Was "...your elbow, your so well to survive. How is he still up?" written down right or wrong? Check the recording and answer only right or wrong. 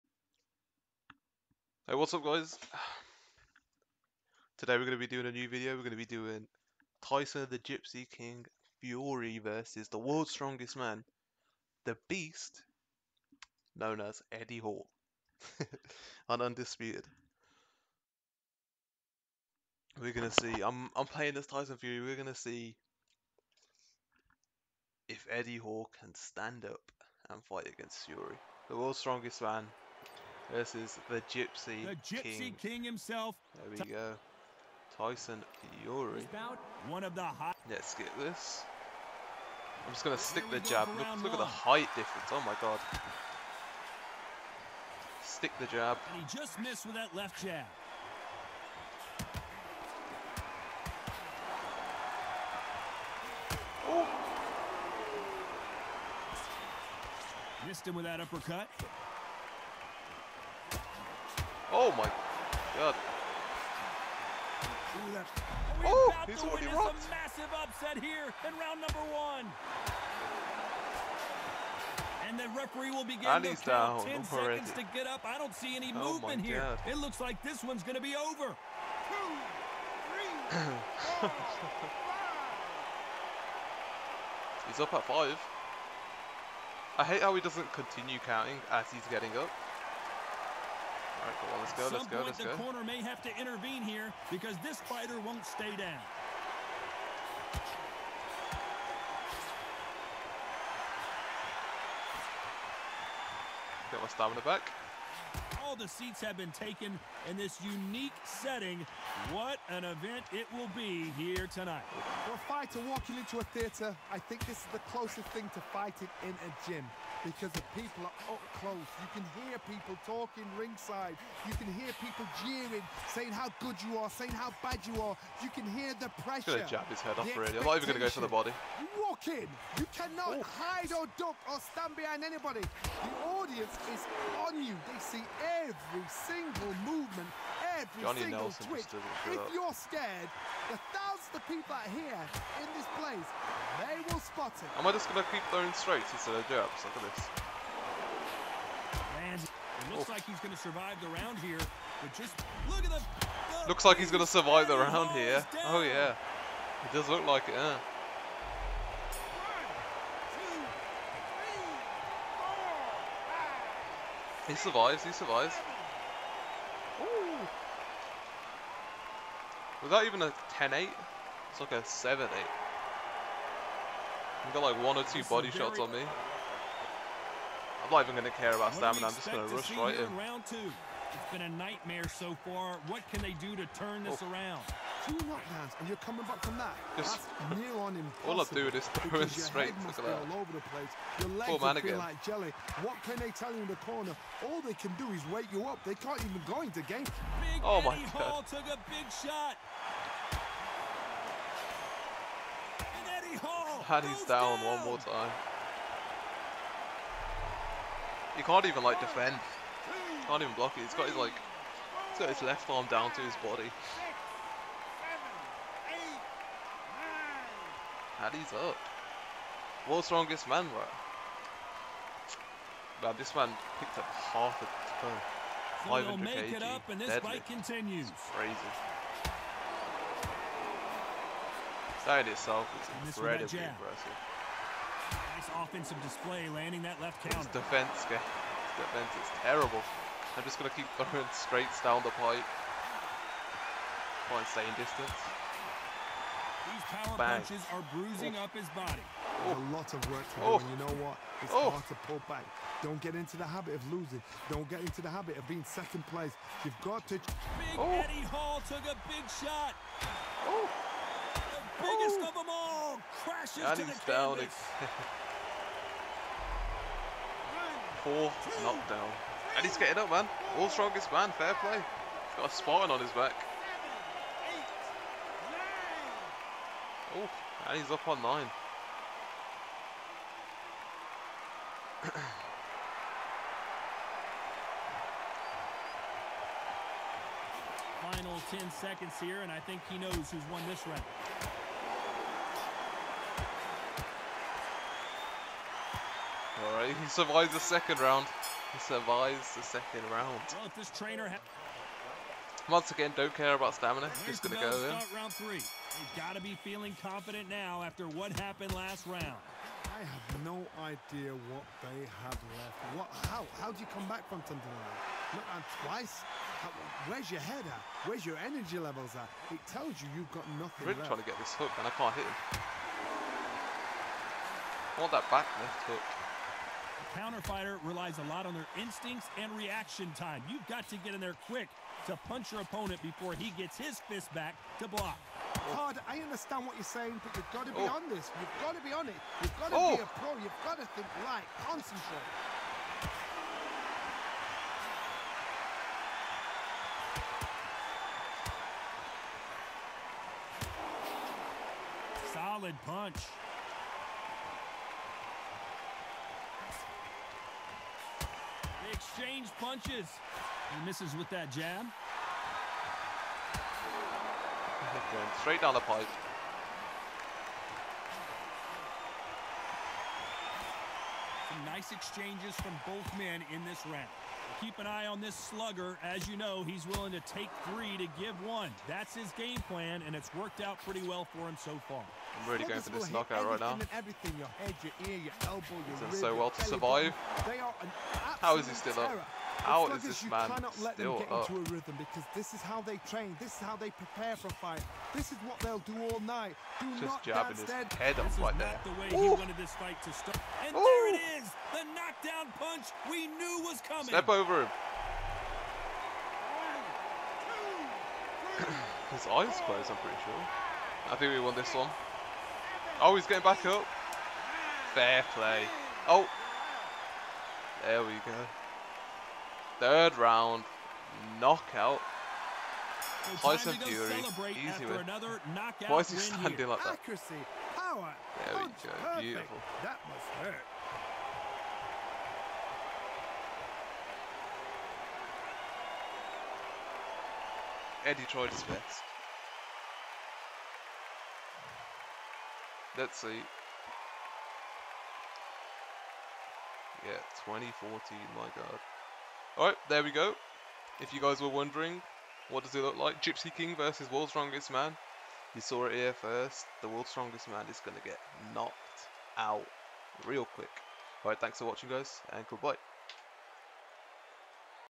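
right.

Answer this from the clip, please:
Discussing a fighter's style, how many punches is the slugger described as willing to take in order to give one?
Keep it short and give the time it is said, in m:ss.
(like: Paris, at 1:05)
3, at 6:17.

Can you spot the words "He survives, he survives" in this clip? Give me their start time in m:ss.
2:44.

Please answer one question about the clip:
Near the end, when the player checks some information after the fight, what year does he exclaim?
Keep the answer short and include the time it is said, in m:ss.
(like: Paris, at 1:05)
2014, at 7:27.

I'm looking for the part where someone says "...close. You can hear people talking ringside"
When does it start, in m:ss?
1:58.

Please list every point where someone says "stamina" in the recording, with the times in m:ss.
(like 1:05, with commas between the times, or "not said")
1:44, 2:58, 5:03.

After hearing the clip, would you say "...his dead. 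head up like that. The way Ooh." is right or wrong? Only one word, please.
right.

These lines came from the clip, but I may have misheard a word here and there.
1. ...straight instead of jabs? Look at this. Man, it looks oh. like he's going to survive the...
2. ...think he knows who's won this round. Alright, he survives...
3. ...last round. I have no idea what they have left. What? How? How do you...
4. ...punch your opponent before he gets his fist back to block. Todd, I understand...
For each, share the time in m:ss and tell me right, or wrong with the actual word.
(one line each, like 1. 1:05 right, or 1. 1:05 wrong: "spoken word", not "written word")
1. 2:25 right
2. 4:49 right
3. 5:08 right
4. 5:32 right.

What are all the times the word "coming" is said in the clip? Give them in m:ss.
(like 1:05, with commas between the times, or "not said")
3:05, 6:43.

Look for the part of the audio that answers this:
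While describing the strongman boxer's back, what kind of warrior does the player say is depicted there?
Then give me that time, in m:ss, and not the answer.
4:32.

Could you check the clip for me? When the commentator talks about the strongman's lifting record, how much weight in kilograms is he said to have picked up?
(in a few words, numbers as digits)
500 kg.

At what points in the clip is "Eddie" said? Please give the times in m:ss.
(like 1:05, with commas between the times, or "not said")
0:14, 0:25, 3:17, 4:17, 7:18.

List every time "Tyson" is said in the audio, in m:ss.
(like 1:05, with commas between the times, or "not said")
0:07, 0:21, 0:34, 7:03.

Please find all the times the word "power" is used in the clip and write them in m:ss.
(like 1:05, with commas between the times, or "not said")
4:06, 7:07.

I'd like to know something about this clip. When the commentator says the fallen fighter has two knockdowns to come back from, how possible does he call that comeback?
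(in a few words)
near on impossible.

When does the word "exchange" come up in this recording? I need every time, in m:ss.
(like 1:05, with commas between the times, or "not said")
5:59, 6:11.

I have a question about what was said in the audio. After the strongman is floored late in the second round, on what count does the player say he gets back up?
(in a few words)
9.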